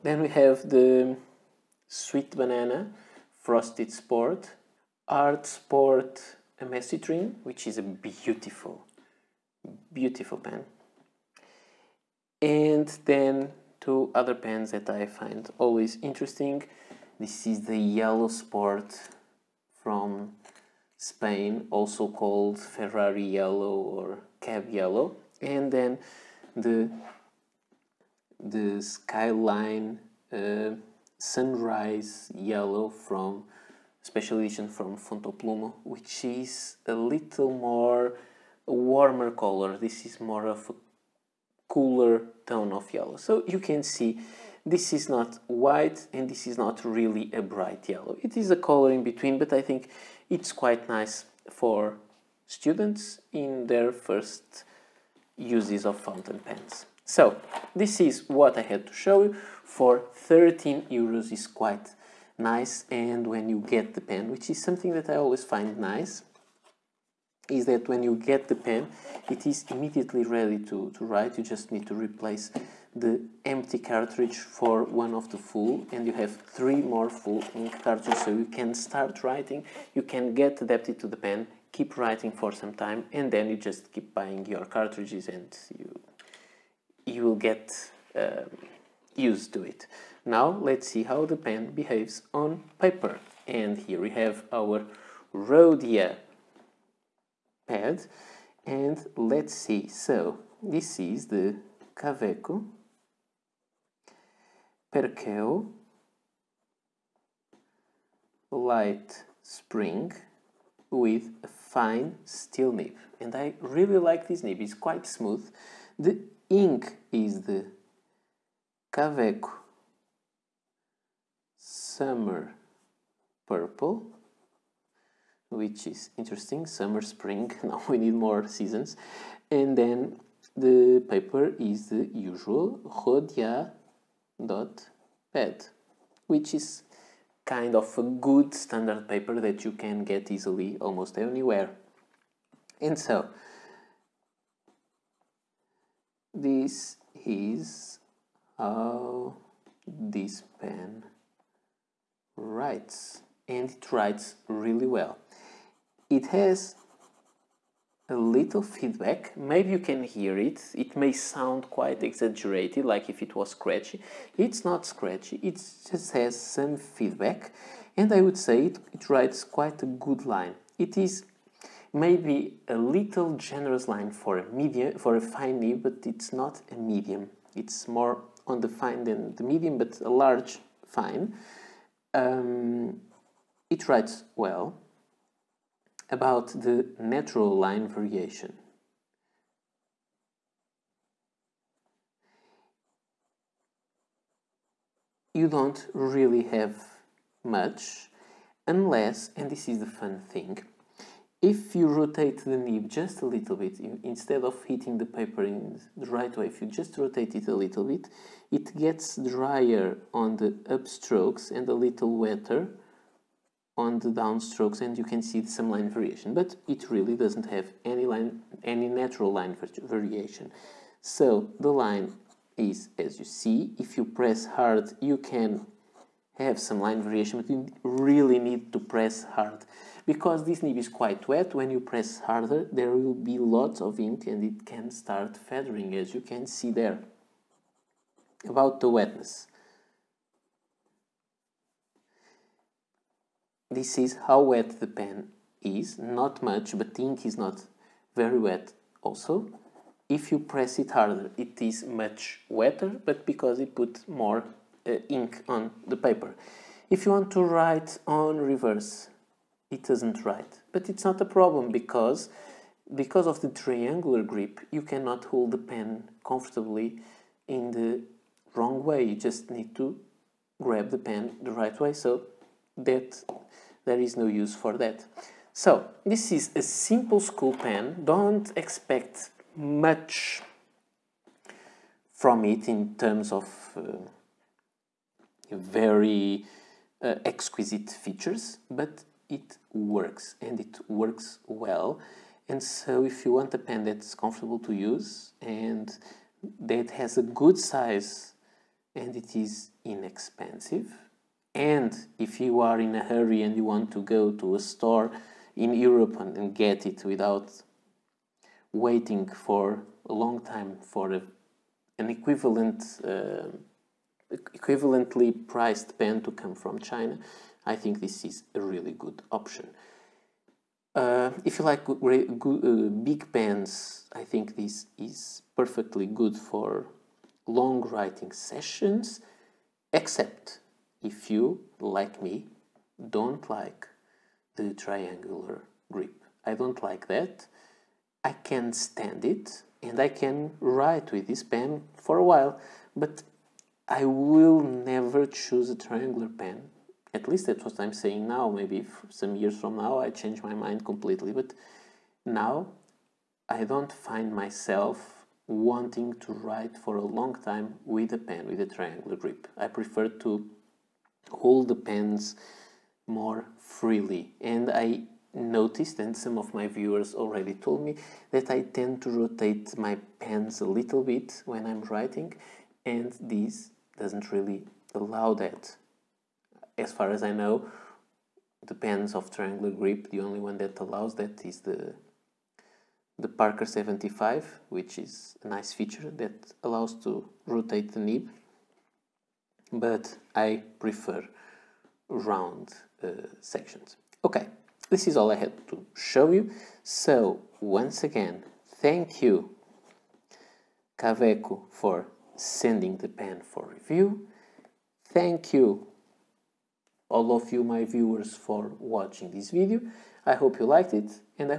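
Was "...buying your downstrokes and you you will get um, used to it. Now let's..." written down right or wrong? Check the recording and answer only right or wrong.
wrong.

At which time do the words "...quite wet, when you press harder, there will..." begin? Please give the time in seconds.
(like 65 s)
230 s.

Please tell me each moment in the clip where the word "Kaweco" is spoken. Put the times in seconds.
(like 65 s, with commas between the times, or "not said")
101 s, 118 s, 400 s.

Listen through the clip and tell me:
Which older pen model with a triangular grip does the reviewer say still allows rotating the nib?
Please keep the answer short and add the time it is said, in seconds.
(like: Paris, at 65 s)
Parker 75, at 383 s.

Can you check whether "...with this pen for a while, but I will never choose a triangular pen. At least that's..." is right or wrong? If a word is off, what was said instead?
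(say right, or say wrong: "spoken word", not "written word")
right.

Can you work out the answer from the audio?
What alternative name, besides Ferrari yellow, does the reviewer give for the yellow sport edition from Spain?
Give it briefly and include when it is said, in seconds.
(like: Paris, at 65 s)
Cab yellow, at 24 s.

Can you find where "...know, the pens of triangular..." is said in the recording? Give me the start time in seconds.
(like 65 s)
377 s.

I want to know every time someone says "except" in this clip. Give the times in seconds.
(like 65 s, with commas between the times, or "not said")
329 s.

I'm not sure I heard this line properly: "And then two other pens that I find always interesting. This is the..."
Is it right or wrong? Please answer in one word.
right.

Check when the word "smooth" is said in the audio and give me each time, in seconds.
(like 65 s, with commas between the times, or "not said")
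115 s.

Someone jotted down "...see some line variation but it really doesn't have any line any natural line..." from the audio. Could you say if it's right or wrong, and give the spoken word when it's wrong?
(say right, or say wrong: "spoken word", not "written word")
right.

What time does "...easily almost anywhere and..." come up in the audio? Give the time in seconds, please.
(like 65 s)
140 s.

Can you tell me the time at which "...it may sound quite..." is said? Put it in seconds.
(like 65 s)
160 s.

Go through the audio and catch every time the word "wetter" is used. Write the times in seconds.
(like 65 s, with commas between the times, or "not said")
212 s, 252 s.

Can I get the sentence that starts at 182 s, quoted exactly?
Um, it writes well about the natural line variation.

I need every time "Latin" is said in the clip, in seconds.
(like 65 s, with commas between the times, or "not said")
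not said.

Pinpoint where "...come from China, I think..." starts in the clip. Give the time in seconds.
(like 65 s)
316 s.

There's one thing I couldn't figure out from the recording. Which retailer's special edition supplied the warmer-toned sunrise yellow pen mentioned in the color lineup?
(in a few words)
Fontoplumo.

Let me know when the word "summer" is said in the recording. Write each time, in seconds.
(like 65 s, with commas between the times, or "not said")
121 s, 126 s.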